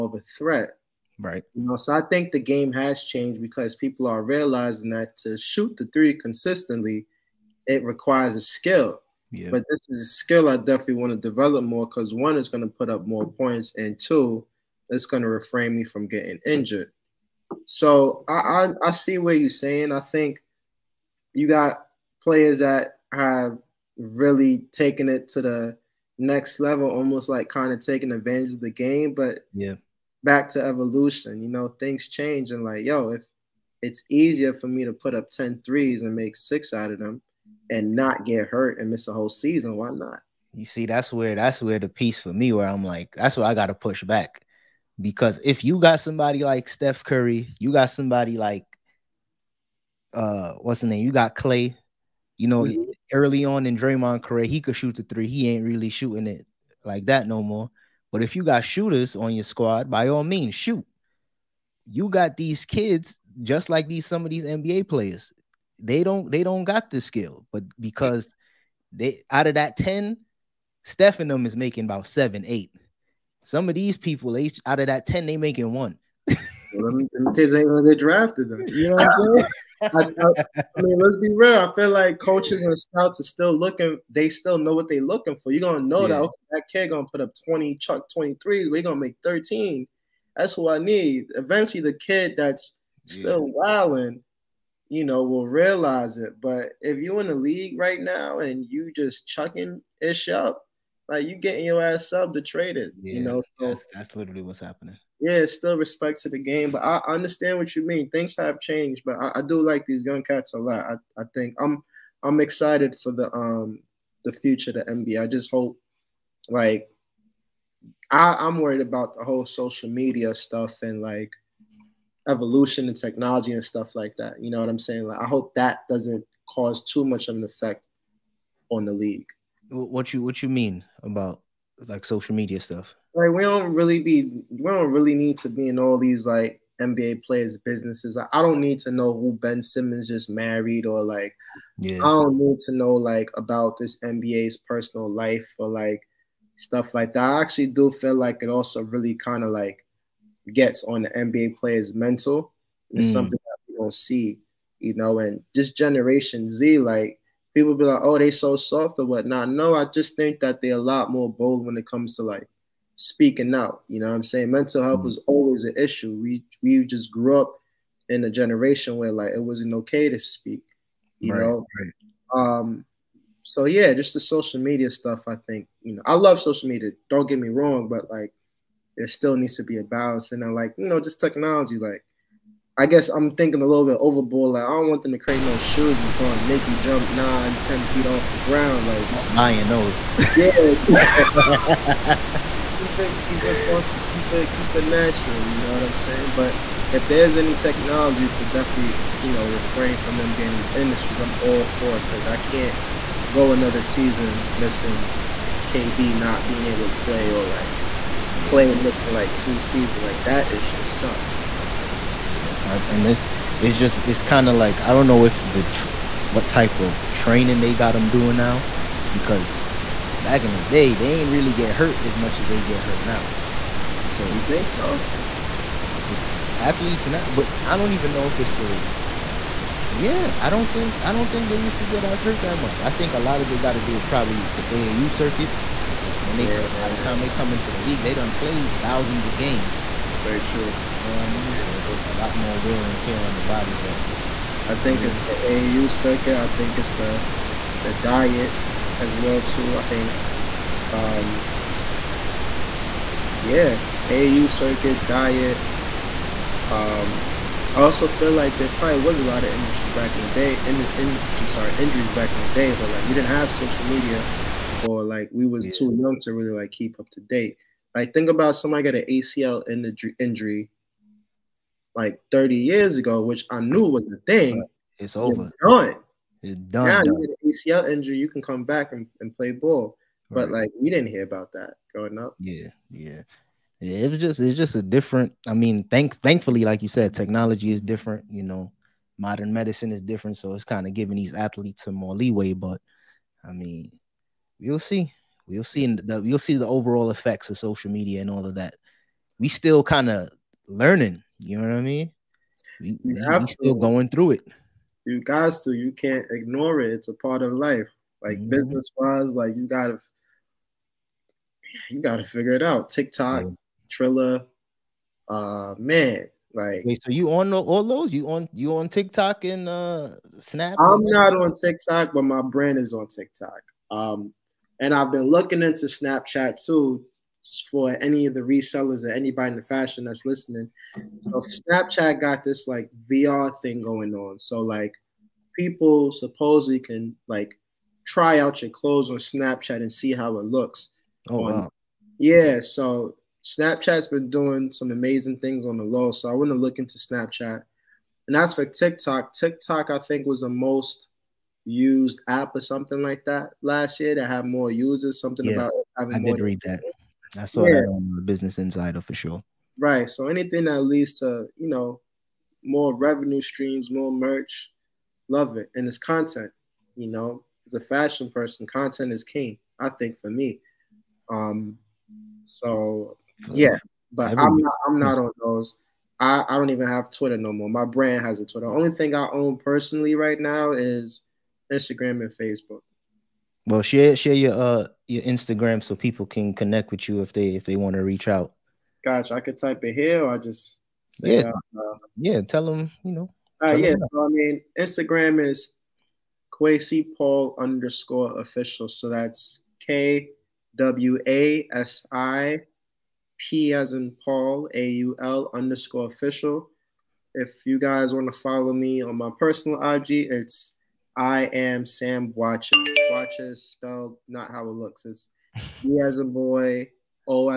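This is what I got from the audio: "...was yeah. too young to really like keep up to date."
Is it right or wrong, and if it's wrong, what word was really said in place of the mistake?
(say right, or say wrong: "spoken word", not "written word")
right.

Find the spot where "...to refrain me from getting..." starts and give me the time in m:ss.
0:15.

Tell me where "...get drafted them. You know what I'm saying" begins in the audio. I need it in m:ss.
1:17.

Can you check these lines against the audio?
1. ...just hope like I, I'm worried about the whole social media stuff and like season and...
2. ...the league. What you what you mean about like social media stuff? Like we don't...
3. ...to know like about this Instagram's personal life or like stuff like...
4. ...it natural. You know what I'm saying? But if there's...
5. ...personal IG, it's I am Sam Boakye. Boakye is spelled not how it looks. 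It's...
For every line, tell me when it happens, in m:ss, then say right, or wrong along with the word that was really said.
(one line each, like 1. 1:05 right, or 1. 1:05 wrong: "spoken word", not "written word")
1. 1:55 wrong: "evolution", not "season"
2. 2:08 right
3. 2:22 wrong: "NBA", not "Instagram"
4. 3:14 right
5. 6:49 right.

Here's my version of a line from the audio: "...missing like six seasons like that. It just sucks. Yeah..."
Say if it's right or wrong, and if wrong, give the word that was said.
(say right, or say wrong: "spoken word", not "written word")
wrong: "two", not "six".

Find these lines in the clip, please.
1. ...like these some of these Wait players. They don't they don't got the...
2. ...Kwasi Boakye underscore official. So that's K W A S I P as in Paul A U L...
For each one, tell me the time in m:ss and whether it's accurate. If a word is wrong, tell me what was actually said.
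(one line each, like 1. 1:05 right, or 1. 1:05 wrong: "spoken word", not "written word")
1. 1:03 wrong: "NBA", not "Wait"
2. 6:36 wrong: "Paul", not "Boakye".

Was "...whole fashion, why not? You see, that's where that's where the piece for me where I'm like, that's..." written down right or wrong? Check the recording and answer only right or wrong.
wrong.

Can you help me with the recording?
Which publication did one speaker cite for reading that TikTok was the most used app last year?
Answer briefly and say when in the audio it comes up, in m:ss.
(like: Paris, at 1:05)
Business Insider, at 5:58.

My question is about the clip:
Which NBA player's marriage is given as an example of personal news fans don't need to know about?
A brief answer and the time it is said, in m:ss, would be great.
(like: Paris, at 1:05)
Ben Simmons, at 2:19.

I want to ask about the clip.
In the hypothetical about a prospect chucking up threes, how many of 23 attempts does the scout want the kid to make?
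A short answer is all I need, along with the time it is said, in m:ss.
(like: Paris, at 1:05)
13, at 1:29.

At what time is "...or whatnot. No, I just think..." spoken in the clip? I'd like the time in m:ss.
2:38.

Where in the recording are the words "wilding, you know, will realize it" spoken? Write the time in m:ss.
1:33.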